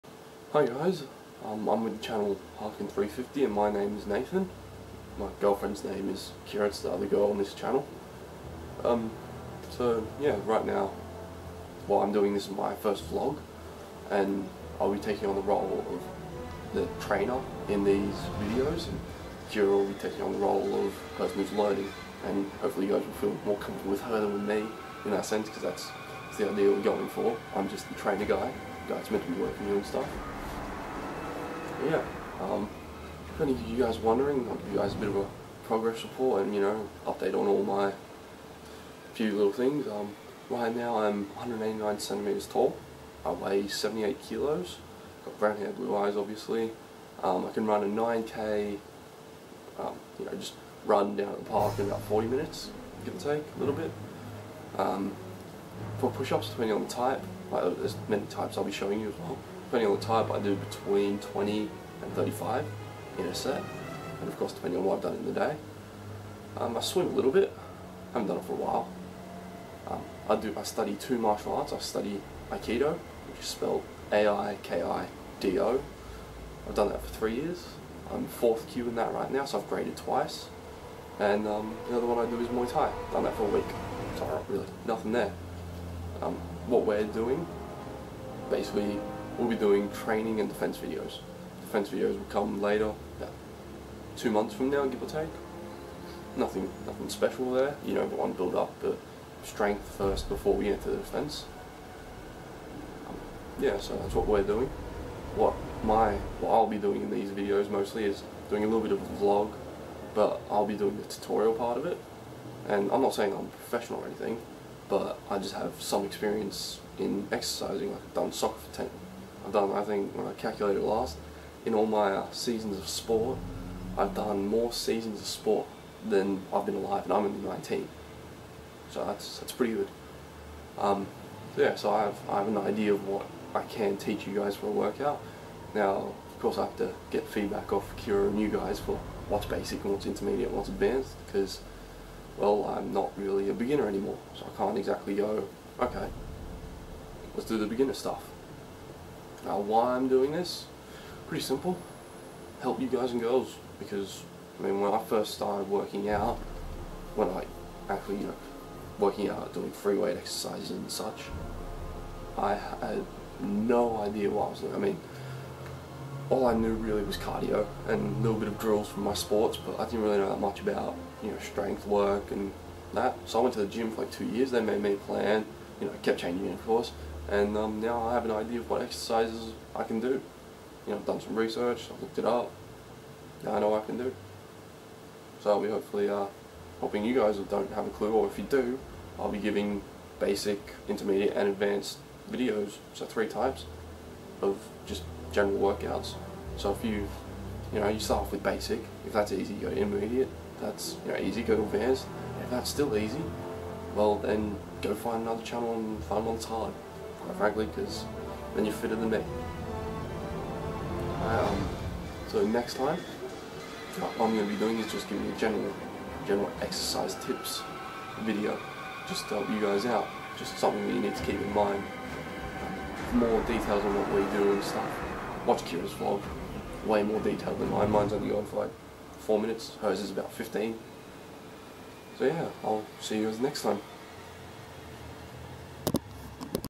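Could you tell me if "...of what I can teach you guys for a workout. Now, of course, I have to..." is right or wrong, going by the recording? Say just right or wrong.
right.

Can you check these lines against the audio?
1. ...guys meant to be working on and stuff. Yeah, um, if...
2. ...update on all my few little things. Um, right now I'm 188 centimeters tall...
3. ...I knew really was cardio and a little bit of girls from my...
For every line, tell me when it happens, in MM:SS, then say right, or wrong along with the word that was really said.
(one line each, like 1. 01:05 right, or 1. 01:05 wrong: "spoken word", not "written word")
1. 00:28 right
2. 00:37 wrong: "189", not "188"
3. 02:46 wrong: "drills", not "girls".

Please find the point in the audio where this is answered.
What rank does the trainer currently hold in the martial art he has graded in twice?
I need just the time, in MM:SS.
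01:18.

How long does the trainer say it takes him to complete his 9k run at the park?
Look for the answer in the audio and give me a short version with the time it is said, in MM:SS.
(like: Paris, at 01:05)
40 minutes, at 00:52.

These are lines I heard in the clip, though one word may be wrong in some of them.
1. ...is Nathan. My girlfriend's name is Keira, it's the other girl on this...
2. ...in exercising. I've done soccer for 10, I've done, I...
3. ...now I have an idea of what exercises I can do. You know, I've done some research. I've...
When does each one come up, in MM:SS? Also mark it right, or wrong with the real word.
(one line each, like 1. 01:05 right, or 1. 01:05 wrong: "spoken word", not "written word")
1. 00:03 right
2. 01:56 right
3. 02:57 right.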